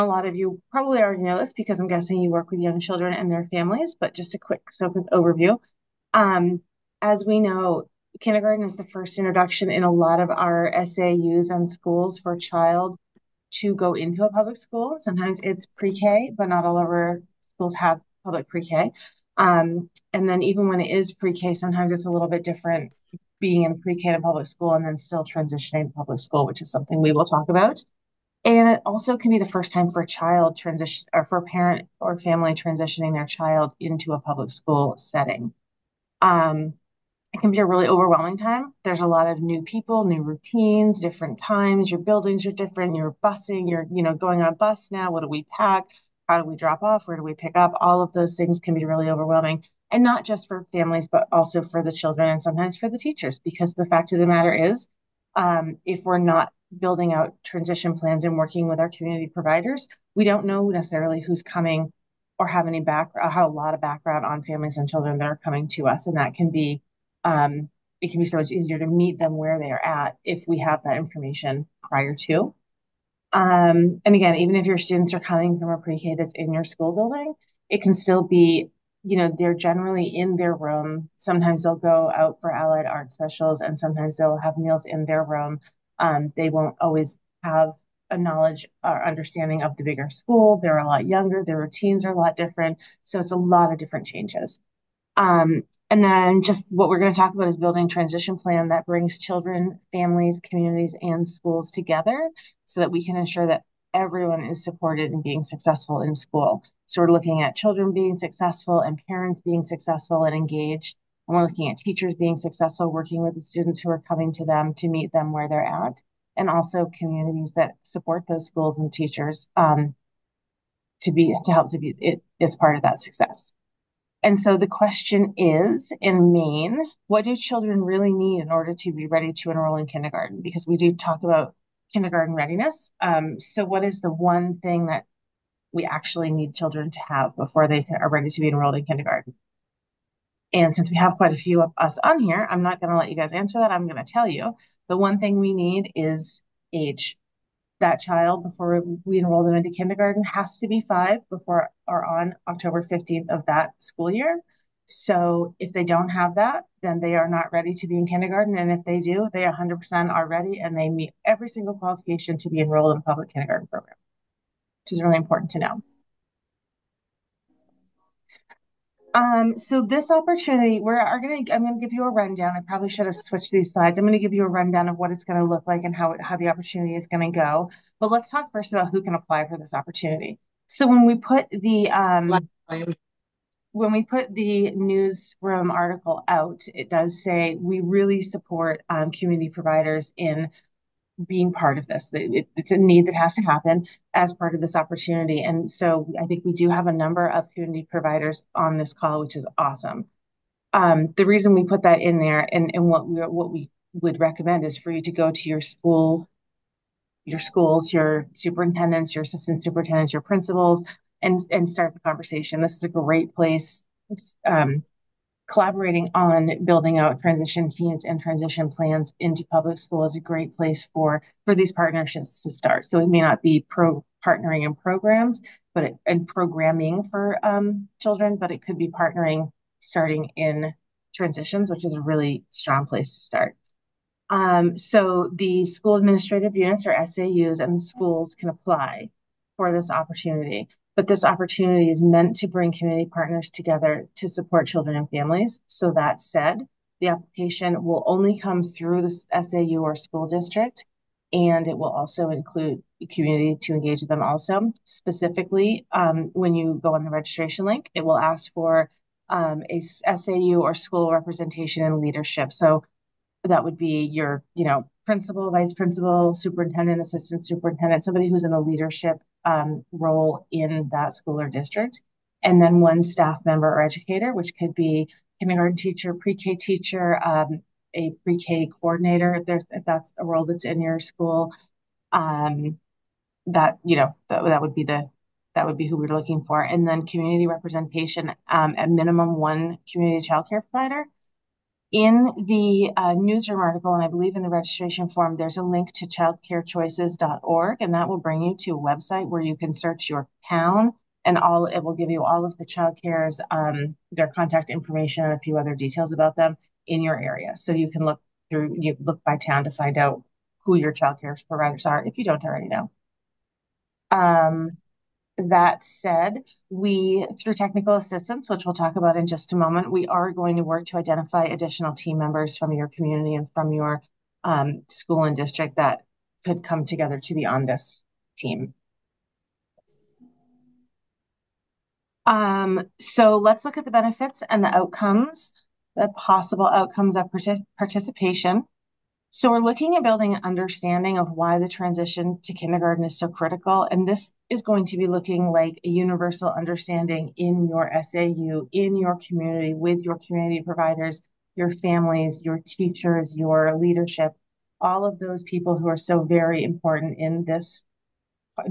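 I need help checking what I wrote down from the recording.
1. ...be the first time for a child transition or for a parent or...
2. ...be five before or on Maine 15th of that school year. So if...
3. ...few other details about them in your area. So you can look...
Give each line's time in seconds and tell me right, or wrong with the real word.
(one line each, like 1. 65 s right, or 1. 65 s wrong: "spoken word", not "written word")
1. 29 s right
2. 150 s wrong: "October", not "Maine"
3. 305 s right.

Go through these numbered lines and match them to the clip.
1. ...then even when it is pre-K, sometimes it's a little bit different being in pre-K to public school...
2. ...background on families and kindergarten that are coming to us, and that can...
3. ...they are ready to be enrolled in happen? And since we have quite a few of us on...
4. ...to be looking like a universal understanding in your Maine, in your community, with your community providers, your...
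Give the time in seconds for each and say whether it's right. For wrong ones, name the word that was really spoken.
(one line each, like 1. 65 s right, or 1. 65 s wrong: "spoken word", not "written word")
1. 20 s right
2. 63 s wrong: "children", not "kindergarten"
3. 137 s wrong: "kindergarten", not "happen"
4. 344 s wrong: "SAU", not "Maine".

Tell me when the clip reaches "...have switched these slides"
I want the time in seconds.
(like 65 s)
173 s.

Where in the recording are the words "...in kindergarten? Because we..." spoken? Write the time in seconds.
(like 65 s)
129 s.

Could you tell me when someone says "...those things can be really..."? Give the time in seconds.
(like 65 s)
48 s.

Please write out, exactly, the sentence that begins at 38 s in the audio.
There's a lot of new people, new routines, different times.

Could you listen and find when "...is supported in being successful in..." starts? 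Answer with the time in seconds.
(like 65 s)
104 s.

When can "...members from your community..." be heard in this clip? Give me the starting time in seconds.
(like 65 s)
322 s.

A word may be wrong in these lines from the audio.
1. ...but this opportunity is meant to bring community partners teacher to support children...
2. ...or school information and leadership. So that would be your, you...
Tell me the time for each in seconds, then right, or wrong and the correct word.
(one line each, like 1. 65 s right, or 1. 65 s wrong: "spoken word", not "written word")
1. 240 s wrong: "together", not "teacher"
2. 260 s wrong: "representation", not "information".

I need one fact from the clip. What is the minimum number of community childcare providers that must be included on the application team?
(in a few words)
1.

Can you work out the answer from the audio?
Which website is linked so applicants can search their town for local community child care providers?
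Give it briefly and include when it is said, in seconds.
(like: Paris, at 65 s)
childcarechoices.org, at 296 s.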